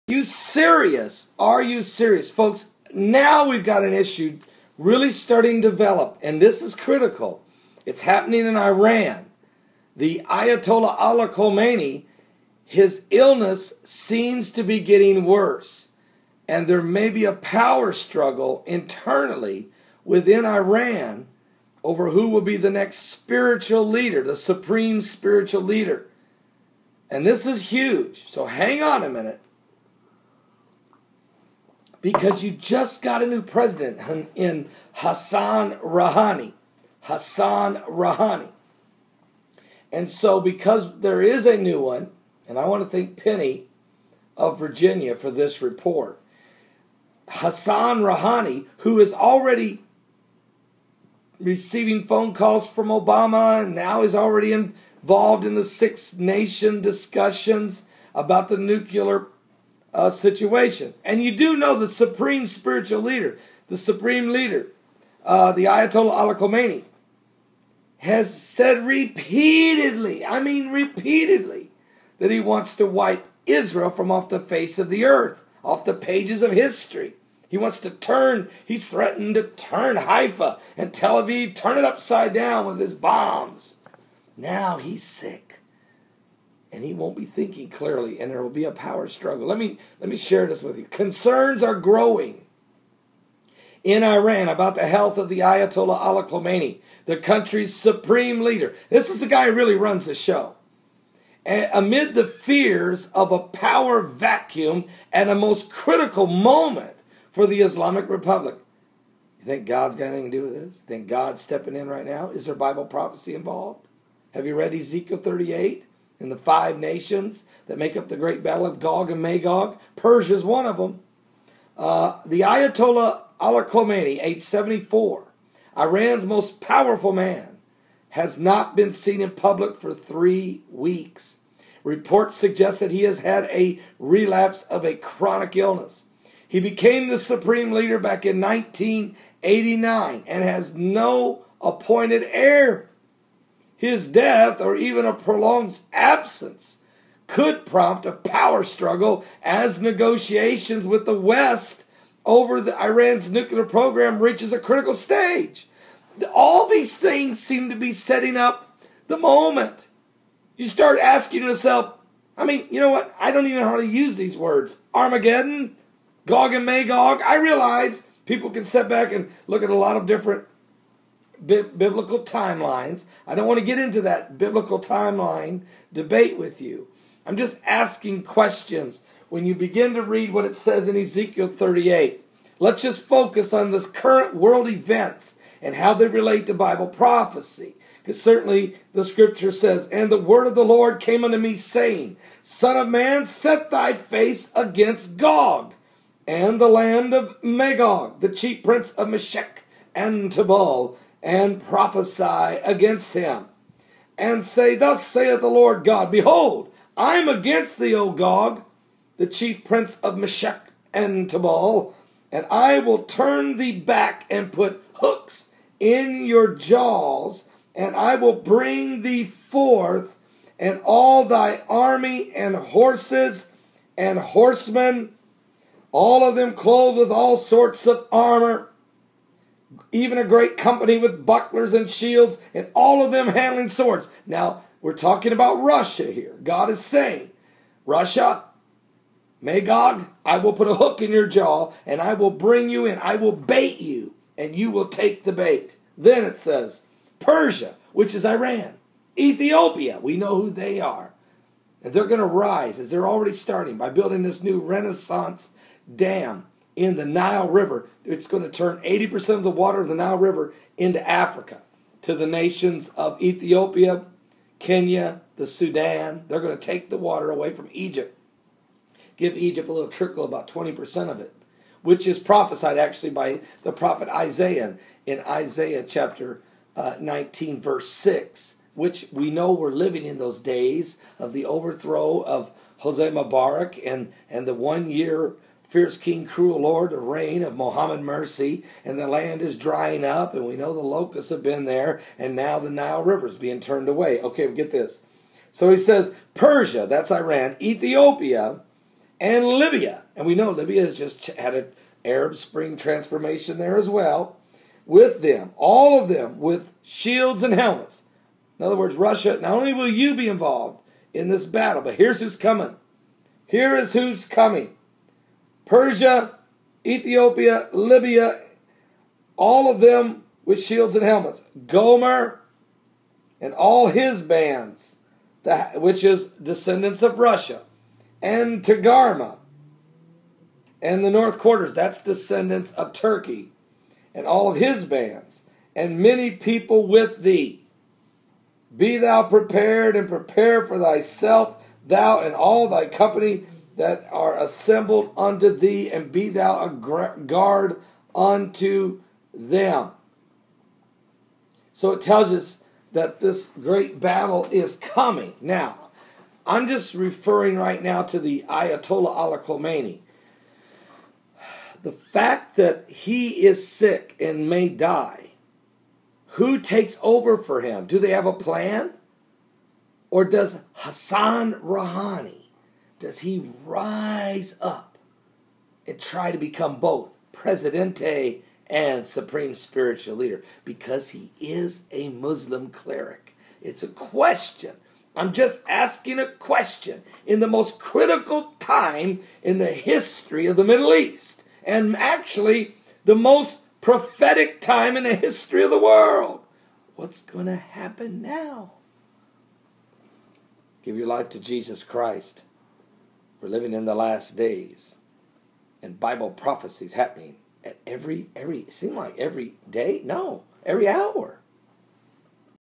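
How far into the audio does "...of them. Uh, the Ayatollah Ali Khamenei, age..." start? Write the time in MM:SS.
02:00.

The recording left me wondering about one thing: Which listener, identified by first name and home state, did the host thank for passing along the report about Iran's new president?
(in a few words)
Penny of Virginia.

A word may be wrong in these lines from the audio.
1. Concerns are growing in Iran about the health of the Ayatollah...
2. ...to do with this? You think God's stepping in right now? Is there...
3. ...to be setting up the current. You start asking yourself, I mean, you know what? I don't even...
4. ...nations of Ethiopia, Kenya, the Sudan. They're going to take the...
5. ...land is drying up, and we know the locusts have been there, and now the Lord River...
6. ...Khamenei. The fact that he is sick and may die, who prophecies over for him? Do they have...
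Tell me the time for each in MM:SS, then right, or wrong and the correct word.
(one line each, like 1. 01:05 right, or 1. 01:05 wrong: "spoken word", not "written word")
1. 01:30 right
2. 01:50 right
3. 02:37 wrong: "moment", not "current"
4. 04:22 right
5. 04:49 wrong: "Nile", not "Lord"
6. 05:59 wrong: "takes", not "prophecies".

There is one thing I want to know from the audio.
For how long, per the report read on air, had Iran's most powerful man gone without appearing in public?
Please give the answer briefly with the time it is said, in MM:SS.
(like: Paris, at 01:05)
3 weeks, at 02:09.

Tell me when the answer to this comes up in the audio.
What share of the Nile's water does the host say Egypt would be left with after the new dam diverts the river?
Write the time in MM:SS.
04:30.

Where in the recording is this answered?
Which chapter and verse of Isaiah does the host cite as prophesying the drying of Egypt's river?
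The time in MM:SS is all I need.
04:36.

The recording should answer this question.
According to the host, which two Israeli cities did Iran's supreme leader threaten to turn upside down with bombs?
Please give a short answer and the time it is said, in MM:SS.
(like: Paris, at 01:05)
Haifa and Tel Aviv, at 01:19.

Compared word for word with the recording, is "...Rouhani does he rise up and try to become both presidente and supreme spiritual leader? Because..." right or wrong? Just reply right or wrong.
right.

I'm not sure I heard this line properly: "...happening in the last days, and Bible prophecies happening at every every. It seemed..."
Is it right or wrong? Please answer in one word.
wrong.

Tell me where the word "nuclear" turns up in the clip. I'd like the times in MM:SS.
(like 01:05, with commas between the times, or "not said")
00:58, 02:33.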